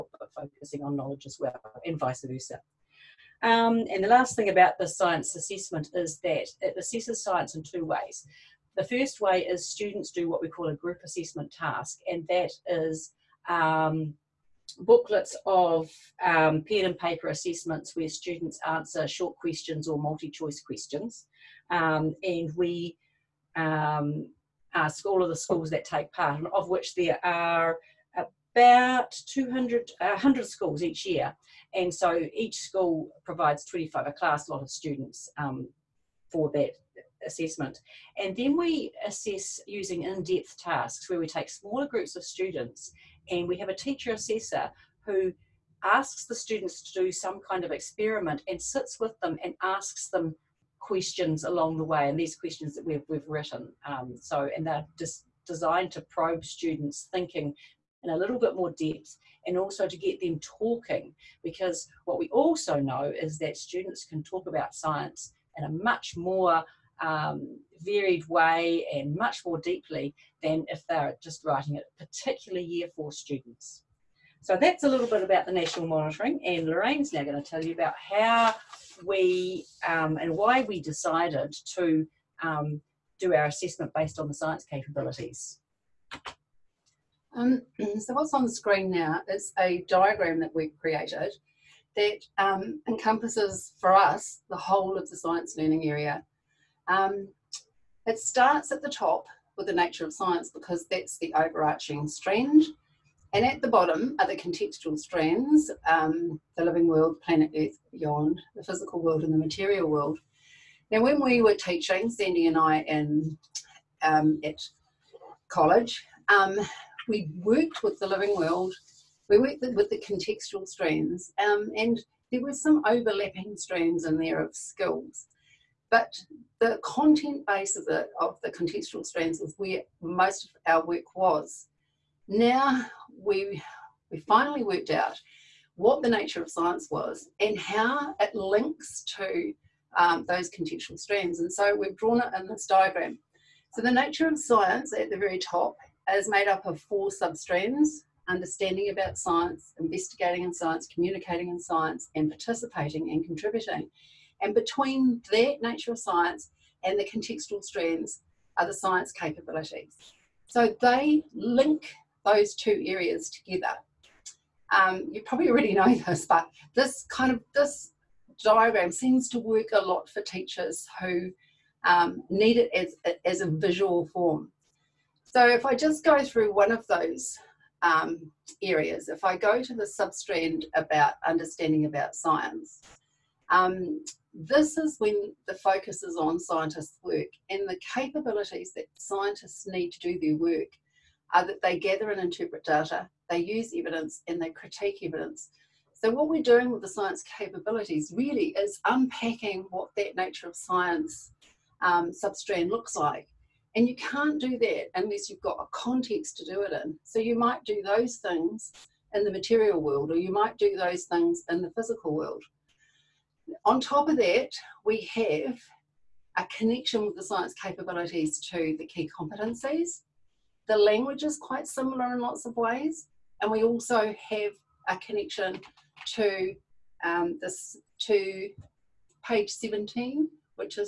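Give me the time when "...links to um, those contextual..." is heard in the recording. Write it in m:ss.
2:18.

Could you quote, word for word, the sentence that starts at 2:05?
But the content base of the, of the contextual strands is where most of our work was.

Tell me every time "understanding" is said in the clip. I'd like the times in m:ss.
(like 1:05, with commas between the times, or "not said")
2:28, 3:01.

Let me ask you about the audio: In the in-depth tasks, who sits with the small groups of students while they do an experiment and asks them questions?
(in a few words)
a teacher assessor.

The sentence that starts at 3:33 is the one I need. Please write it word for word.
On top of that, we have a connection with the science capabilities to the key competencies.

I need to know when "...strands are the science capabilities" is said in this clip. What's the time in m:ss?
2:37.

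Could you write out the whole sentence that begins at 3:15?
So, what we're doing with the science capabilities really is unpacking what that nature of science um, substrand looks like.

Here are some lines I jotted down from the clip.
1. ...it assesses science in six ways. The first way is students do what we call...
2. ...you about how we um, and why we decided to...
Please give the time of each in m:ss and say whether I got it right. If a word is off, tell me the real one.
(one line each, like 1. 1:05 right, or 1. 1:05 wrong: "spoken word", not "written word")
1. 0:06 wrong: "two", not "six"
2. 1:17 right.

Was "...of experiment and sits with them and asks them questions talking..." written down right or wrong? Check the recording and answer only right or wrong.
wrong.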